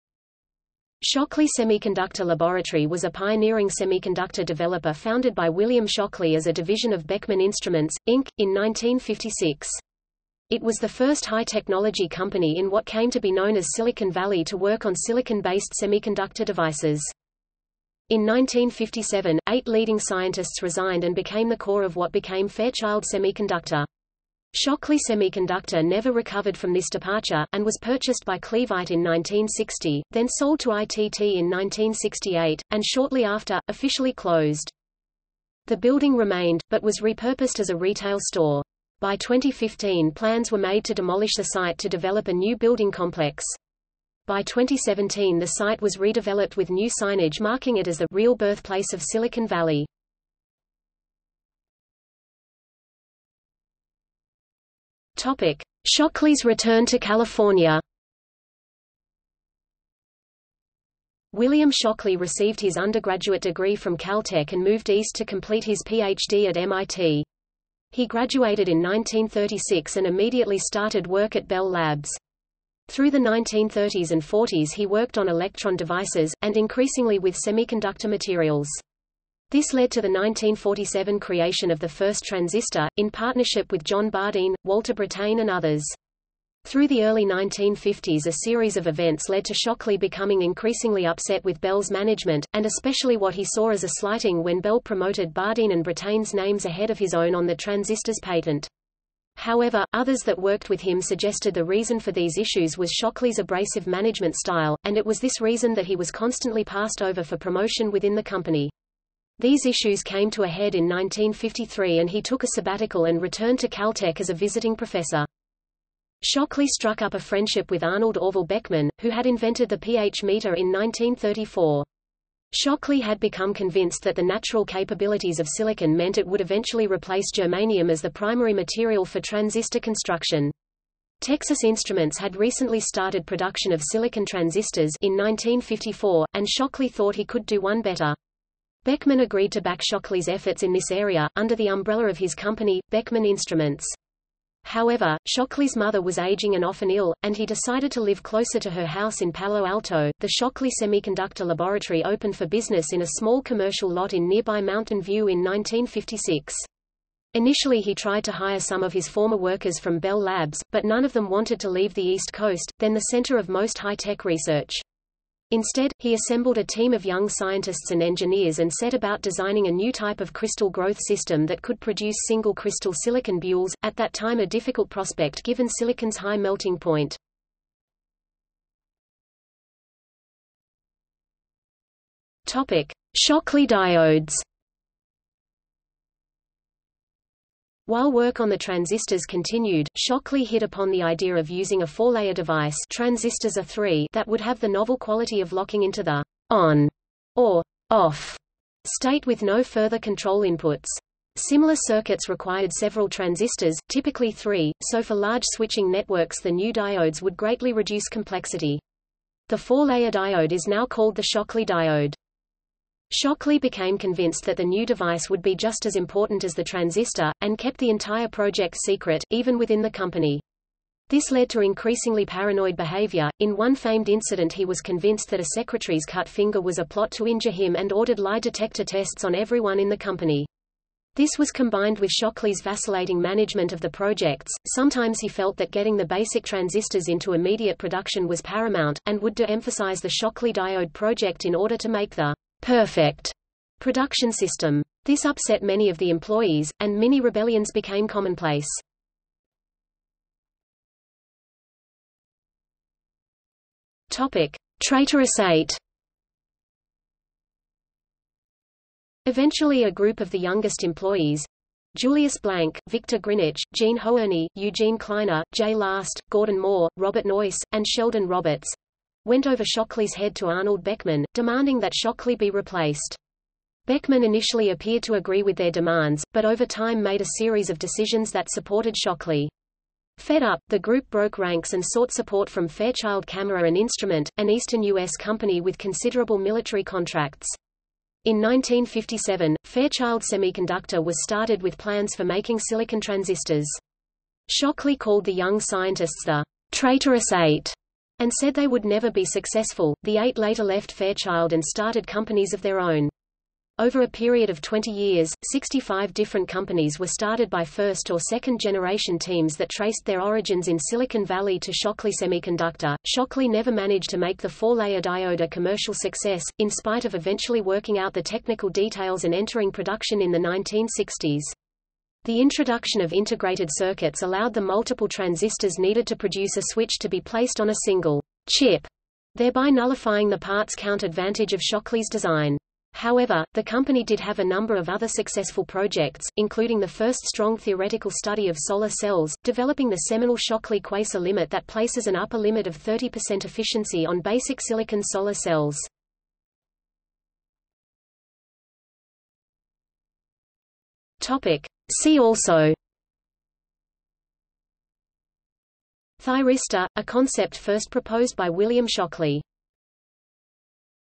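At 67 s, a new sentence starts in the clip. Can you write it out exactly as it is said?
He graduated in 1936 and immediately started work at Bell Labs.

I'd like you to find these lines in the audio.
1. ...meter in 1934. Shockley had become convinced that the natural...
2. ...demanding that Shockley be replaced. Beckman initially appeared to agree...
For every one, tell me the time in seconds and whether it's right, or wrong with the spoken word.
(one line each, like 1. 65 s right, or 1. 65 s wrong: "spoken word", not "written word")
1. 120 s right
2. 271 s right.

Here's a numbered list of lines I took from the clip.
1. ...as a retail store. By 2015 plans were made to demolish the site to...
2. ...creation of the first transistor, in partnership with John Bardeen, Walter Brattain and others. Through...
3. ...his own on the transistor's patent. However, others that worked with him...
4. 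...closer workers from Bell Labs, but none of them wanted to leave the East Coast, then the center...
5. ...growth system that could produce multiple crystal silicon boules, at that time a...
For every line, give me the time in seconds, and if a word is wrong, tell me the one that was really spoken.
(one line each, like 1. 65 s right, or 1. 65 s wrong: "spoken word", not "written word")
1. 37 s right
2. 81 s right
3. 96 s right
4. 159 s wrong: "former", not "closer"
5. 170 s wrong: "single", not "multiple".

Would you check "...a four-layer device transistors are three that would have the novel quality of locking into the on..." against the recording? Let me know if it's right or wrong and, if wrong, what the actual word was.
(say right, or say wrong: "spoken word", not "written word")
right.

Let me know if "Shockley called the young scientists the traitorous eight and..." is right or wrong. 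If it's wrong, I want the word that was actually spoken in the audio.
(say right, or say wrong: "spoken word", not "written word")
right.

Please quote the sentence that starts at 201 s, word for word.
Similar circuits required several transistors, typically three, so for large switching networks the new diodes would greatly reduce complexity.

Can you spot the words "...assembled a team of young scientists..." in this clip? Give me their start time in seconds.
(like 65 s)
166 s.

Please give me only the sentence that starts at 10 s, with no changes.
It was the first high-technology company in what came to be known as Silicon Valley to work on silicon-based semiconductor devices.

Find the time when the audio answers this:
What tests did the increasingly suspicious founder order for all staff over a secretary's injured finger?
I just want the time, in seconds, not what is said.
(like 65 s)
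228 s.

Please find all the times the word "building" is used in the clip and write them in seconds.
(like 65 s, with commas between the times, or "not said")
35 s, 42 s.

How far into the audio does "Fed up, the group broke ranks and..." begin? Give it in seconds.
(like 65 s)
280 s.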